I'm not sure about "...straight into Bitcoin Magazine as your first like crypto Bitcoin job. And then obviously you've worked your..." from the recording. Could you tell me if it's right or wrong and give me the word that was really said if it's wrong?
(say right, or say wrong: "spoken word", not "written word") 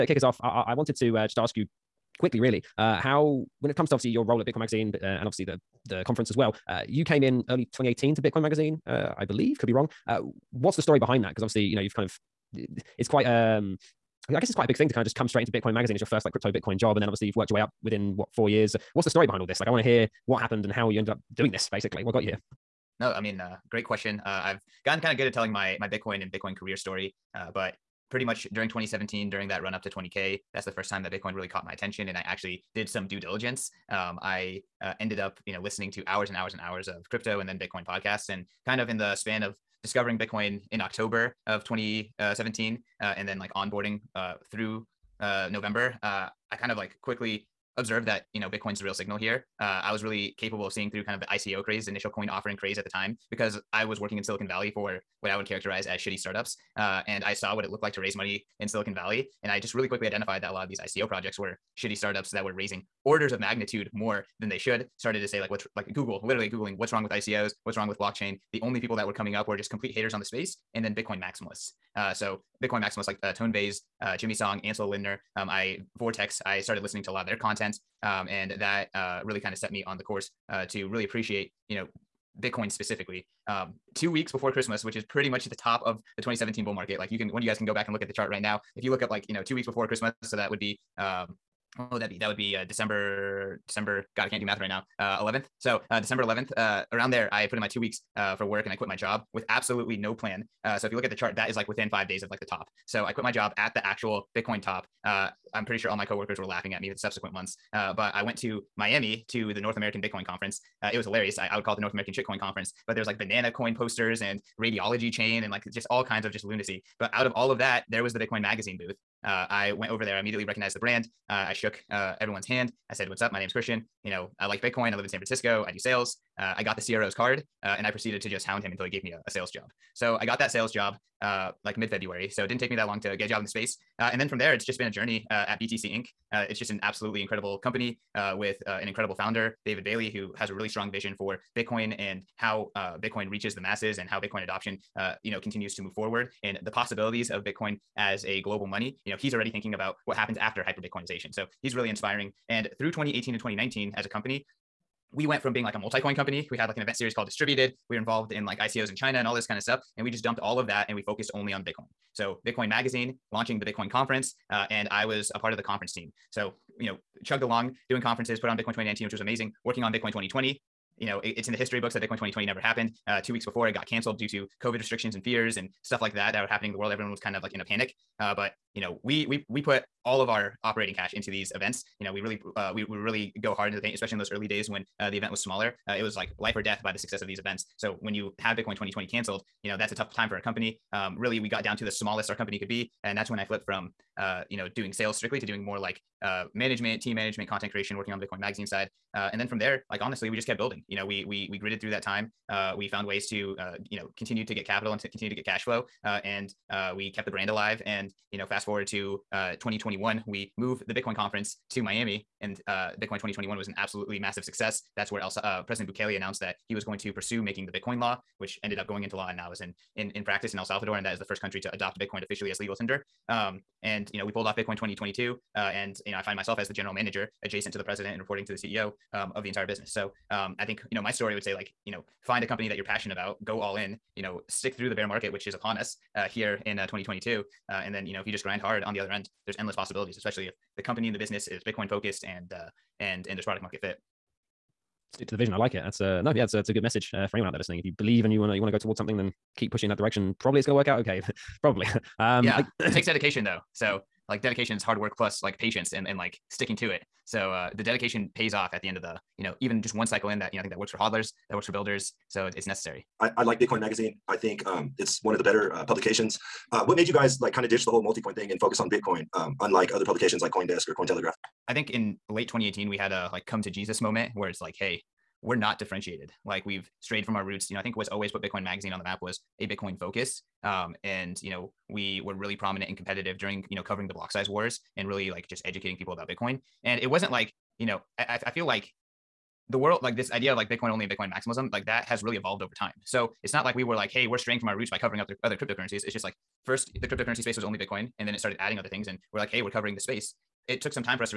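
right.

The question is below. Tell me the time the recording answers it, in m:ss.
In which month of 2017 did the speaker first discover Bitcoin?
0:40.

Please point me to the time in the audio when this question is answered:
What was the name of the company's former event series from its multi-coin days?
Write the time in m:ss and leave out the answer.
2:37.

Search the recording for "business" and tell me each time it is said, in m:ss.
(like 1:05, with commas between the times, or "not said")
3:49, 4:01.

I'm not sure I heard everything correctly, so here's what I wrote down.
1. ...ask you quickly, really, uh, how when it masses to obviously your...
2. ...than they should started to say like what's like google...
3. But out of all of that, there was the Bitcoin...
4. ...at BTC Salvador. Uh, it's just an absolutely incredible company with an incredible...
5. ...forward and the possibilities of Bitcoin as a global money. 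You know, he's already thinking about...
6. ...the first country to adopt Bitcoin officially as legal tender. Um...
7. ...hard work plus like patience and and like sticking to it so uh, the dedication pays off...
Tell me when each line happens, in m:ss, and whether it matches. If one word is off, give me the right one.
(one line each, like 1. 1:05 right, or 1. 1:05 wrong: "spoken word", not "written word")
1. 0:01 wrong: "comes", not "masses"
2. 1:04 right
3. 1:57 right
4. 2:15 wrong: "Inc", not "Salvador"
5. 2:25 right
6. 3:41 right
7. 4:14 right.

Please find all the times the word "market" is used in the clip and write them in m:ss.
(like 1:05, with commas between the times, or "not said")
1:26, 3:55, 4:03.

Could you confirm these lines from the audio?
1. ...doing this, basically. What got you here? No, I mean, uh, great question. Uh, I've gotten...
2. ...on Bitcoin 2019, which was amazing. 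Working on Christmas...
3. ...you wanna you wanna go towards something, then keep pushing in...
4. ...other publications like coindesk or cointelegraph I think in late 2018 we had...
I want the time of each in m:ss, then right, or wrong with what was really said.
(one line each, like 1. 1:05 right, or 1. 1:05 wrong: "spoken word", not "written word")
1. 0:21 right
2. 2:48 wrong: "Bitcoin", not "Christmas"
3. 4:08 right
4. 4:29 right.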